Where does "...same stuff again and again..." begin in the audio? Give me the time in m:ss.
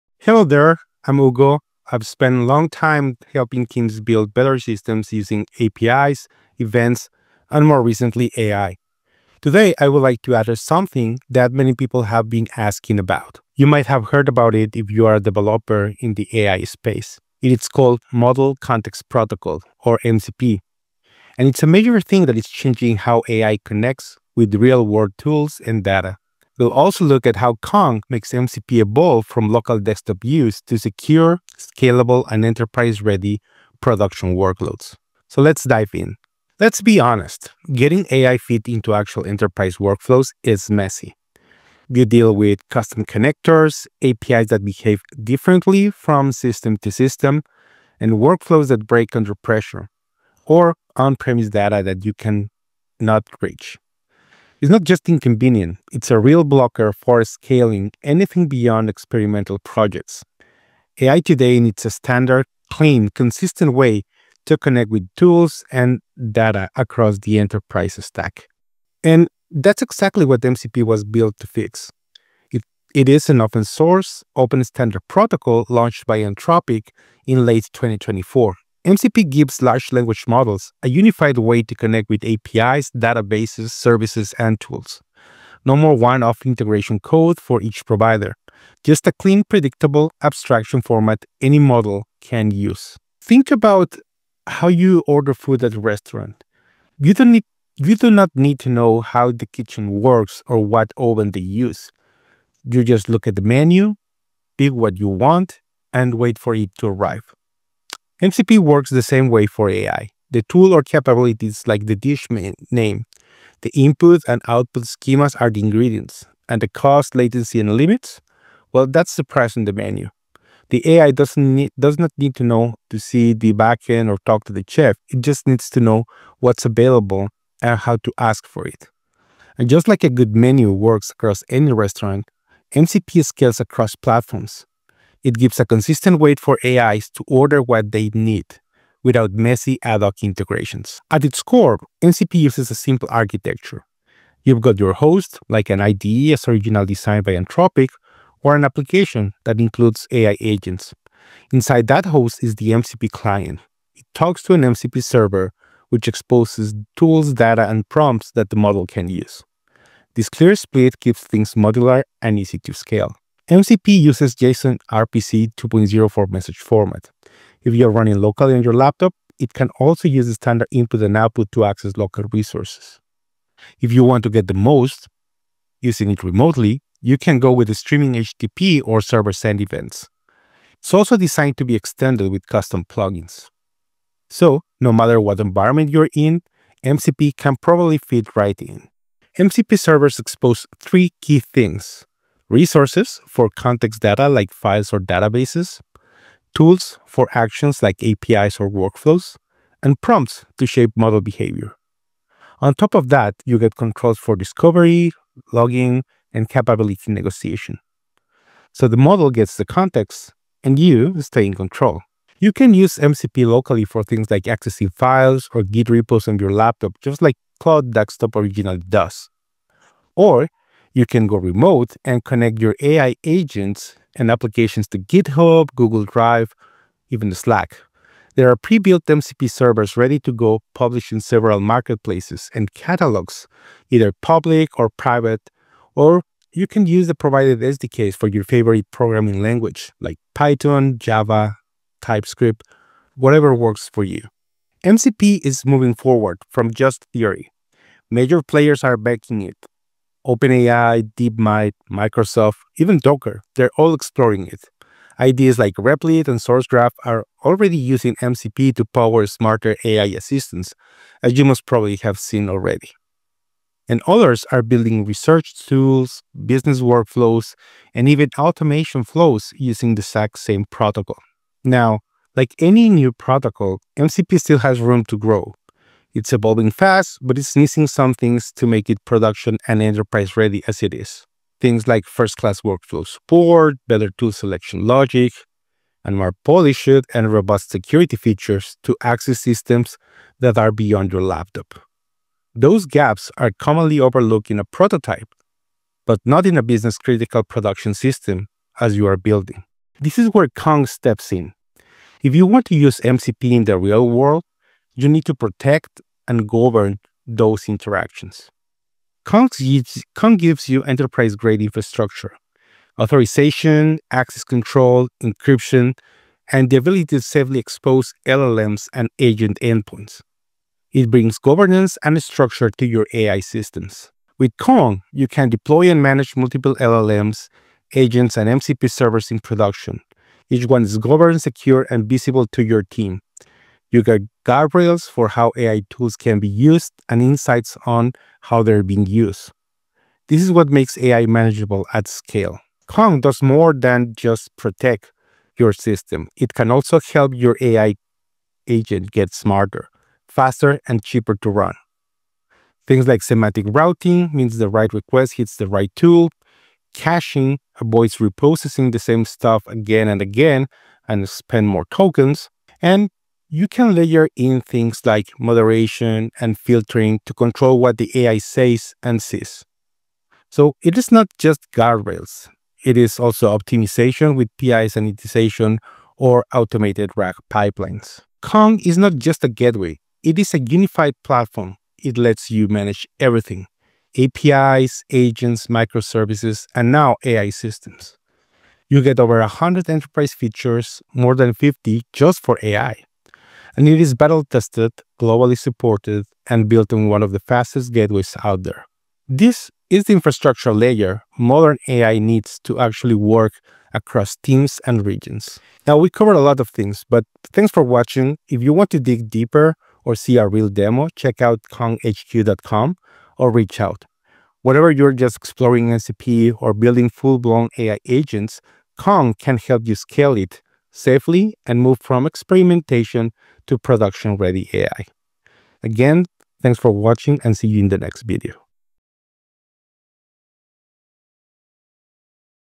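5:58.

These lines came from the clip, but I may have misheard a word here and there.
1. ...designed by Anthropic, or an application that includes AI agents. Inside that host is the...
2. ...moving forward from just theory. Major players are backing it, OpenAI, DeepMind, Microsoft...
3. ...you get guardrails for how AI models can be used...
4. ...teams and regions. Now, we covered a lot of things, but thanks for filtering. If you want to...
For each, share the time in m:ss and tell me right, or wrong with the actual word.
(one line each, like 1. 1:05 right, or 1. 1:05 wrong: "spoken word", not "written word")
1. 2:26 right
2. 4:05 right
3. 5:33 wrong: "tools", not "models"
4. 6:44 wrong: "watching", not "filtering".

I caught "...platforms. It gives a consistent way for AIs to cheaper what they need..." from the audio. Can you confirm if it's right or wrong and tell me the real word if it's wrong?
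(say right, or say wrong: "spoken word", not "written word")
wrong: "order", not "cheaper".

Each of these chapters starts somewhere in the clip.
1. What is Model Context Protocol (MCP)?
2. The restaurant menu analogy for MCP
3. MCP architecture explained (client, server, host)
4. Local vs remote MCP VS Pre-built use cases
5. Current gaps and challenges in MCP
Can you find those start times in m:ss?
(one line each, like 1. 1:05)
1. 1:10
2. 2:05
3. 2:21
4. 3:30
5. 4:31.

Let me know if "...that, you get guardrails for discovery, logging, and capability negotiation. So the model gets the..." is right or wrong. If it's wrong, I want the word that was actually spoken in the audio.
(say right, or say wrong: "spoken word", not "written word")
wrong: "controls", not "guardrails".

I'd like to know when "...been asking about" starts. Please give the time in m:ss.
0:12.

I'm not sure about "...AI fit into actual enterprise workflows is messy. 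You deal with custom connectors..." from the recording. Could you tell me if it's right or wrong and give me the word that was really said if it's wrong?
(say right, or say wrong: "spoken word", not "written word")
right.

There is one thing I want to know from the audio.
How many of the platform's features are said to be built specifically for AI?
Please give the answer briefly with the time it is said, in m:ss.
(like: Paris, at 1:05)
more than 50, at 6:31.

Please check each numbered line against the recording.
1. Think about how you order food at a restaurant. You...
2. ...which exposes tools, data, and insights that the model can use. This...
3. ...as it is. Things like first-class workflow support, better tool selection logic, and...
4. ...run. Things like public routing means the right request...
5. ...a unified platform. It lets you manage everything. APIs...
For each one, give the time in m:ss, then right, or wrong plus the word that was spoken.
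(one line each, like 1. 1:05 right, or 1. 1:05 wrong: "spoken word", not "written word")
1. 1:33 right
2. 2:35 wrong: "prompts", not "insights"
3. 4:40 right
4. 5:51 wrong: "semantic", not "public"
5. 6:20 right.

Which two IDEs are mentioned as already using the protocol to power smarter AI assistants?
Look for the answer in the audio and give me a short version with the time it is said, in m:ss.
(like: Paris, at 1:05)
Replit and SourceGraph, at 4:15.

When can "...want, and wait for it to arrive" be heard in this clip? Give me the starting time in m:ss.
1:45.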